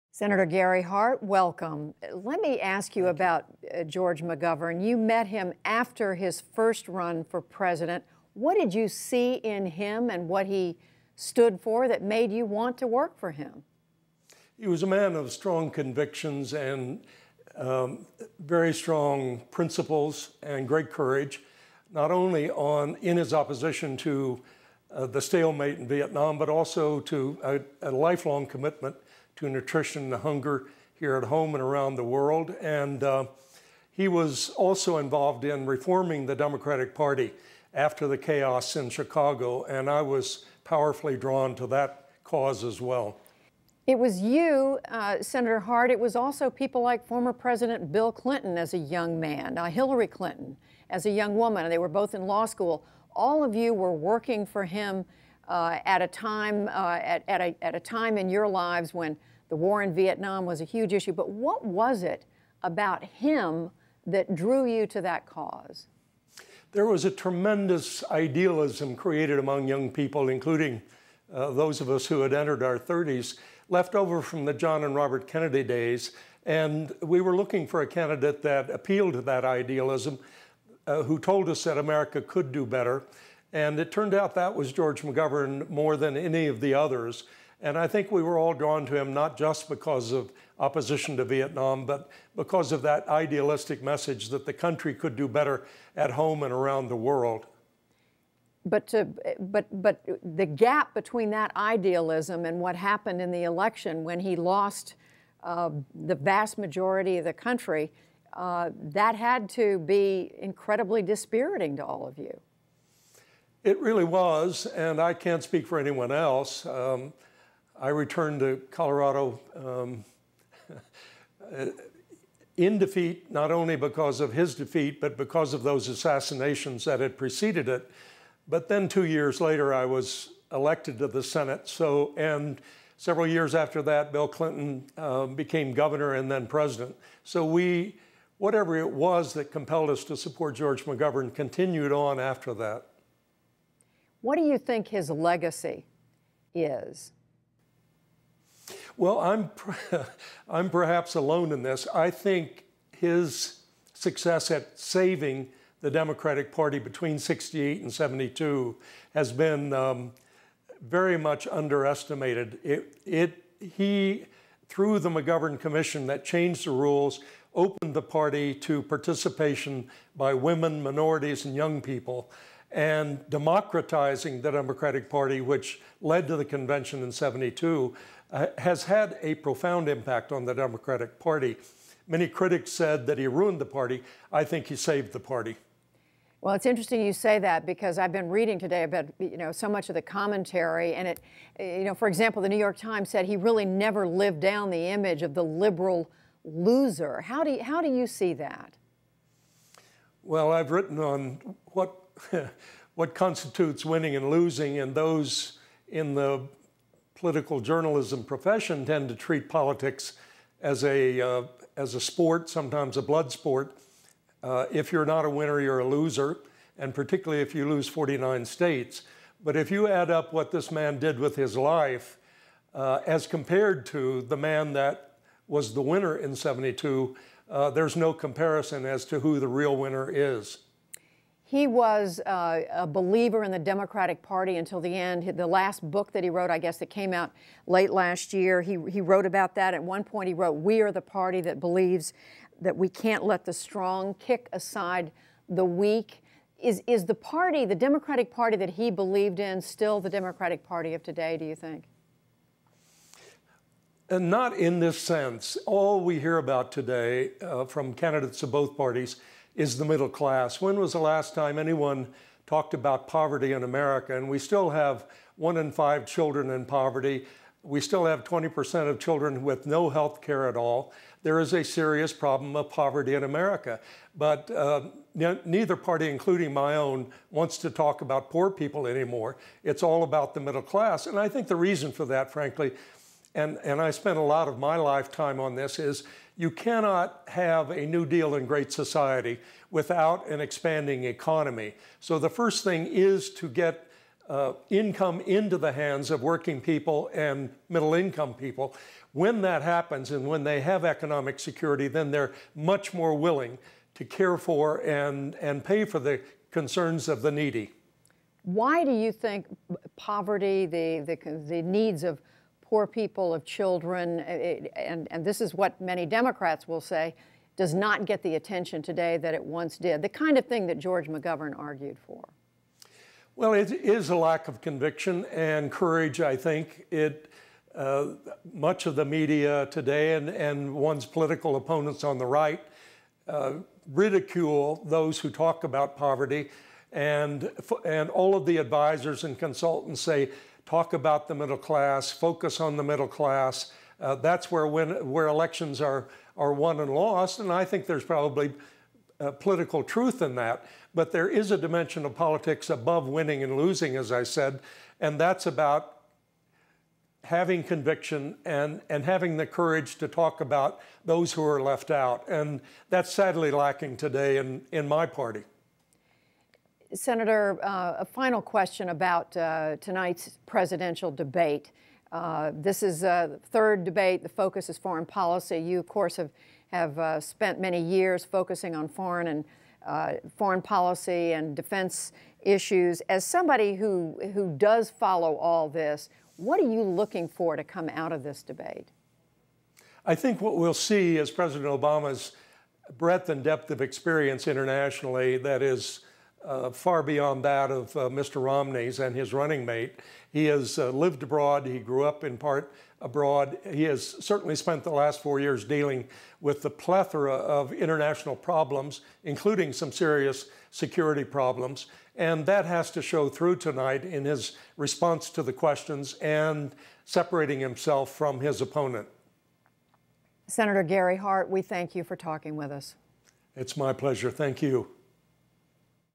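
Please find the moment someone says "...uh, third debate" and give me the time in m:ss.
6:13.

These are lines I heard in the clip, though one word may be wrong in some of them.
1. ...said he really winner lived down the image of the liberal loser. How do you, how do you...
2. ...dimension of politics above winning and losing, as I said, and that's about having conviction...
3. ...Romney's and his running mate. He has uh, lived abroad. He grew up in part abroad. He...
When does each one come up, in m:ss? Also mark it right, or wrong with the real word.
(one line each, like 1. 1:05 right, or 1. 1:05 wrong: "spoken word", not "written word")
1. 3:13 wrong: "never", not "winner"
2. 5:51 right
3. 6:38 right.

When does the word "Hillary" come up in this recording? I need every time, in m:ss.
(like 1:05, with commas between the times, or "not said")
0:49.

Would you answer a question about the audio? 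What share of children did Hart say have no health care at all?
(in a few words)
20%.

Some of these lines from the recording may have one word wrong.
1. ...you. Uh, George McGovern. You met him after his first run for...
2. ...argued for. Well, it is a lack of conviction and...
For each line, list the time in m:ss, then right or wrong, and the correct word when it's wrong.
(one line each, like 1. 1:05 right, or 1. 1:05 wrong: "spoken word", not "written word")
1. 0:03 right
2. 5:21 right.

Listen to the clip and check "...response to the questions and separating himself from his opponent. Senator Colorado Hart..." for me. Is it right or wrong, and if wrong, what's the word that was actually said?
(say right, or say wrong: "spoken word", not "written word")
wrong: "Gary", not "Colorado".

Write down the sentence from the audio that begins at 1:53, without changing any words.
It really was, and I can't speak for anyone else.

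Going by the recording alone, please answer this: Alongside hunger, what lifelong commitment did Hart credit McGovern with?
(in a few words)
Nutrition.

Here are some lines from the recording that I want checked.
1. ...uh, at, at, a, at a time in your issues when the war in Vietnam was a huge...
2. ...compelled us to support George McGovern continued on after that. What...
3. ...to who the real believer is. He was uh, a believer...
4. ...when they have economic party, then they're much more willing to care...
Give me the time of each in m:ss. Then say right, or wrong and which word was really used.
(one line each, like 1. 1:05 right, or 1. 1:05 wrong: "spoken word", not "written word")
1. 0:56 wrong: "lives", not "issues"
2. 2:19 right
3. 3:49 wrong: "winner", not "believer"
4. 5:00 wrong: "security", not "party".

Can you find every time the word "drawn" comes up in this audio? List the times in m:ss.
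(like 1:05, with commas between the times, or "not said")
0:41, 1:28.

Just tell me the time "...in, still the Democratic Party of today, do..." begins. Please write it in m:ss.
4:09.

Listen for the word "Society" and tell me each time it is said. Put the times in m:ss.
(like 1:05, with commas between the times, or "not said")
4:48.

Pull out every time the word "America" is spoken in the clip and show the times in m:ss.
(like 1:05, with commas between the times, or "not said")
1:21, 4:23, 4:33.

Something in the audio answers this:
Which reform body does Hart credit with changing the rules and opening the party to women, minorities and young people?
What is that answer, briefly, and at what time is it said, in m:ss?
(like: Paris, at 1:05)
McGovern Commission, at 2:45.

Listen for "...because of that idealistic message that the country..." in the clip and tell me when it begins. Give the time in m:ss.
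1:32.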